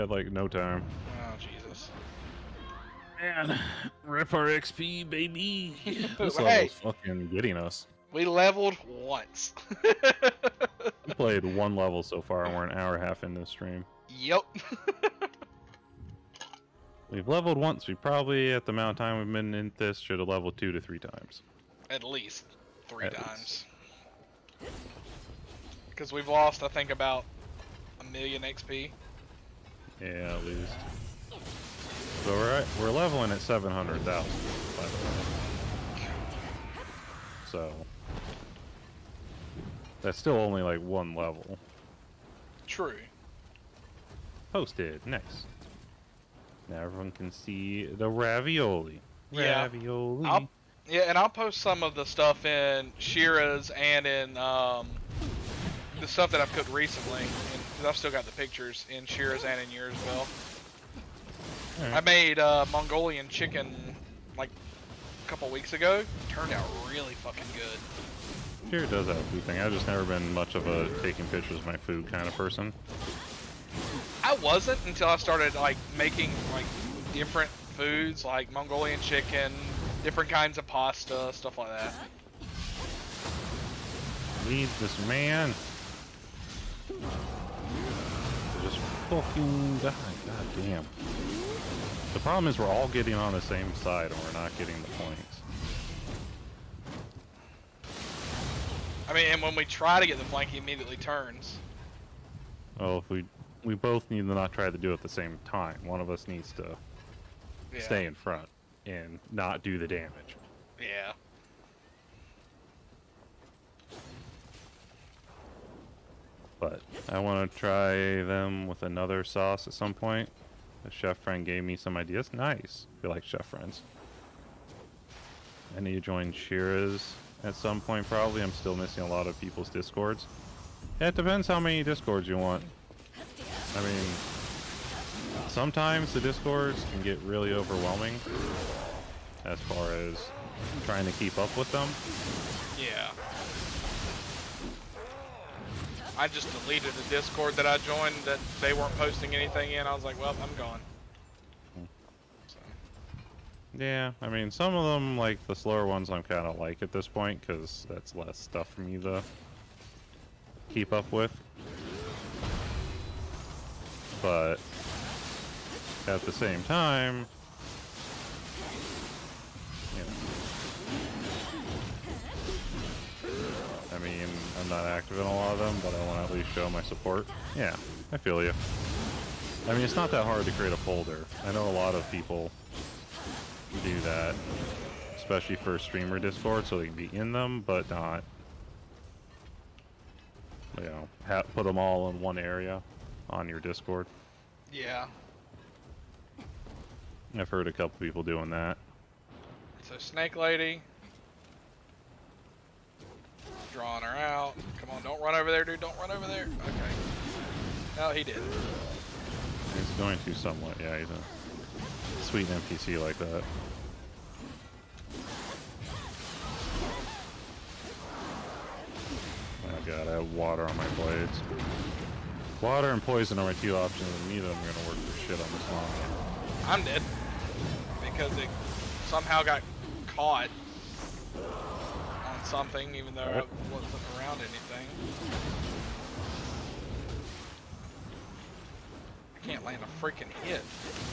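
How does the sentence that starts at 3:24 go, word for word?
Come on, don't run over there, dude.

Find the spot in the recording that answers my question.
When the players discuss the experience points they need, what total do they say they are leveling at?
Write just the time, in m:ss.
0:33.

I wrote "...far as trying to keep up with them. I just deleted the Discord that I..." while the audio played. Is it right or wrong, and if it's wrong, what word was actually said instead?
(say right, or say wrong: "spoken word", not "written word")
right.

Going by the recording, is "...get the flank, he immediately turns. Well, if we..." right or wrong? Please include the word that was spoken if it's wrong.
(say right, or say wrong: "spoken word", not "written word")
right.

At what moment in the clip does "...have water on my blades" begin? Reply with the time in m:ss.
3:40.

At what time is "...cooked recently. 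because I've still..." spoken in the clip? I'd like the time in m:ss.
0:56.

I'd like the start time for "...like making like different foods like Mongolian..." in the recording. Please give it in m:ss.
1:15.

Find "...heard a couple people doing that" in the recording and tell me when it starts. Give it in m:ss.
3:17.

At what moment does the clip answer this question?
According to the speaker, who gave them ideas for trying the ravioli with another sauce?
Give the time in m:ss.
2:00.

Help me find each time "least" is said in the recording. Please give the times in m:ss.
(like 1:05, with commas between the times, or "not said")
0:22, 0:30, 2:56.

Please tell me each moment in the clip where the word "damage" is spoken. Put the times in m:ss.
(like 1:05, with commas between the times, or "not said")
1:49.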